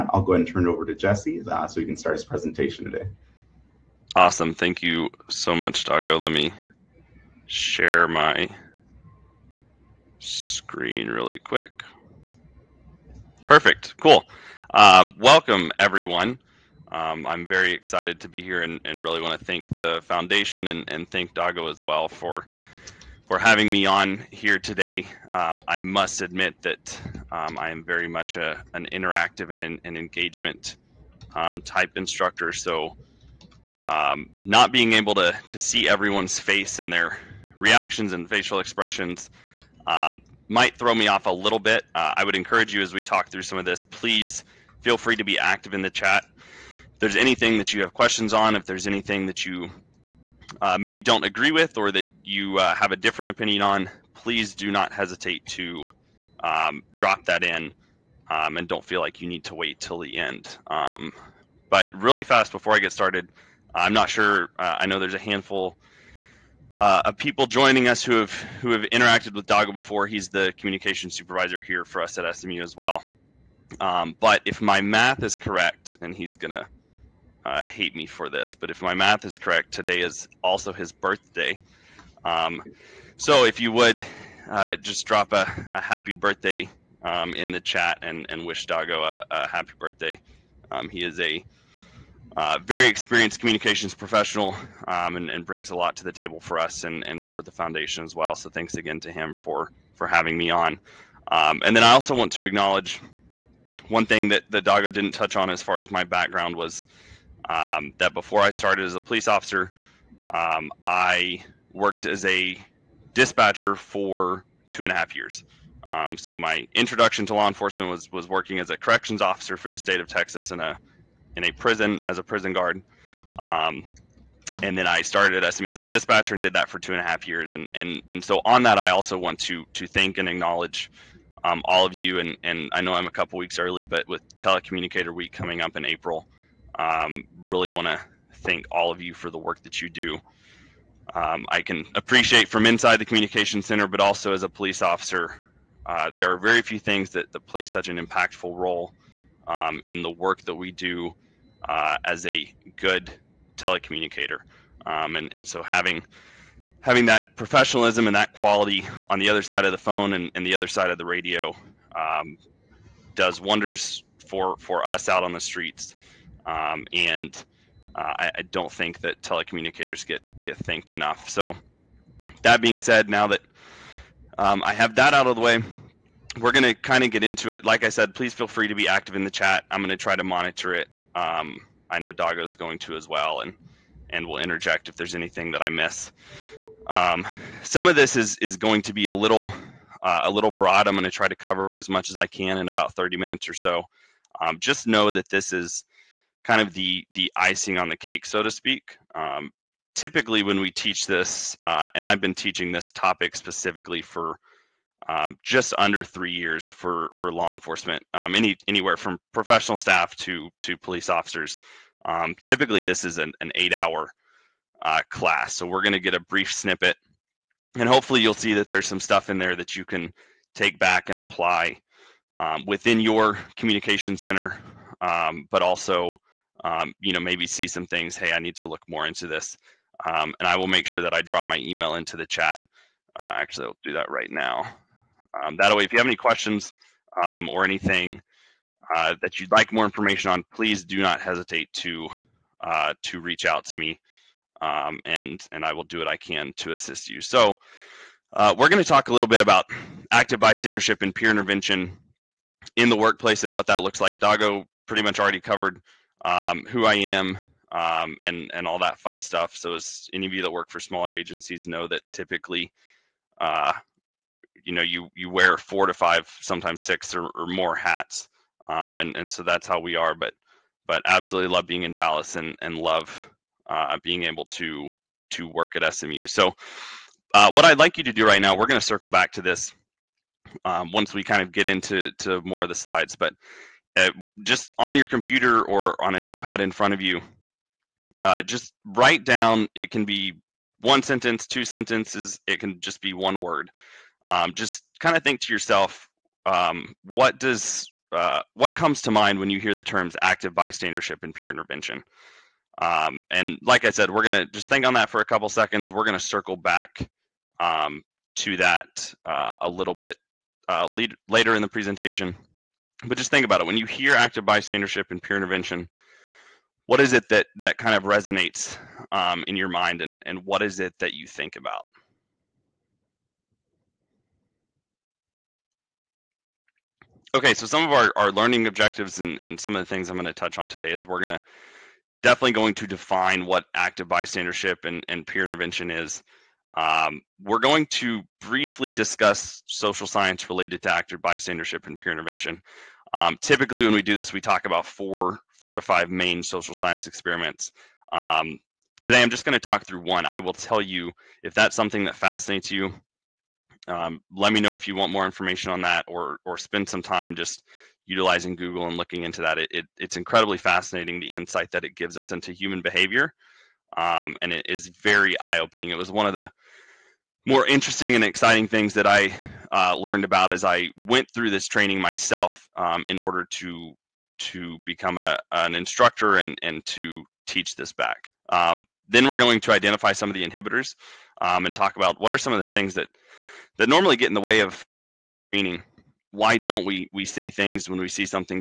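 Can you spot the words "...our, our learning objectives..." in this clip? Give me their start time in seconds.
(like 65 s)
327 s.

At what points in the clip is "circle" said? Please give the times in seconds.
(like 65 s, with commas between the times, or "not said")
278 s, 306 s.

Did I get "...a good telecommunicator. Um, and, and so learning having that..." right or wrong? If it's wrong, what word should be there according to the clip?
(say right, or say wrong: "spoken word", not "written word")
wrong: "having", not "learning".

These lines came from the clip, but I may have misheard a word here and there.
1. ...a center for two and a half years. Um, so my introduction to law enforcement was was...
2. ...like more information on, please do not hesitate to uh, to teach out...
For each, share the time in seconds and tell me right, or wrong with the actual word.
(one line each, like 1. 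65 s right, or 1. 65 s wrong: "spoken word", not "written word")
1. 112 s wrong: "dispatcher", not "center"
2. 239 s wrong: "reach", not "teach".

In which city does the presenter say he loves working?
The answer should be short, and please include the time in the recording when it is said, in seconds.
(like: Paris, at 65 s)
Dallas, at 271 s.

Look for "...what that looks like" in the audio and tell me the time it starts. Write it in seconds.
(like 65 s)
253 s.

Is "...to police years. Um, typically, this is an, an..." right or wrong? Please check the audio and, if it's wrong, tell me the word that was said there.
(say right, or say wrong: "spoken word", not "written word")
wrong: "officers", not "years".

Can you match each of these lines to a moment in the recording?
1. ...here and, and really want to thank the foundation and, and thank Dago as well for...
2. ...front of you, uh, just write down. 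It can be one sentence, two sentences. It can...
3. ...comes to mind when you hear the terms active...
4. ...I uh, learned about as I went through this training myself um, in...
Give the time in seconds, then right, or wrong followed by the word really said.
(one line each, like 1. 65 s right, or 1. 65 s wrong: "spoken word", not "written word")
1. 18 s right
2. 286 s right
3. 298 s right
4. 369 s right.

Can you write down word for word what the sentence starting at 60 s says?
Um, but really fast before I get started, I'm not sure.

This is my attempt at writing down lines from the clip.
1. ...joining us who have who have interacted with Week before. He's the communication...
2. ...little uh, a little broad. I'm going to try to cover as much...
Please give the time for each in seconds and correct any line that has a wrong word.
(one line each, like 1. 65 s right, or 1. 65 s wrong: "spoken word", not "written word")
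1. 67 s wrong: "Dago", not "Week"
2. 189 s right.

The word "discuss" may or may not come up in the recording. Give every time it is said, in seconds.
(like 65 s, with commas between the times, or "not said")
338 s.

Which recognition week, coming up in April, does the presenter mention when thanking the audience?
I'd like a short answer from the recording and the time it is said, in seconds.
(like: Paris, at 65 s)
Telecommunicator Week, at 134 s.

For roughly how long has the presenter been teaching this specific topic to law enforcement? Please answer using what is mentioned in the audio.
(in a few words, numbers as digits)
just under 3 years.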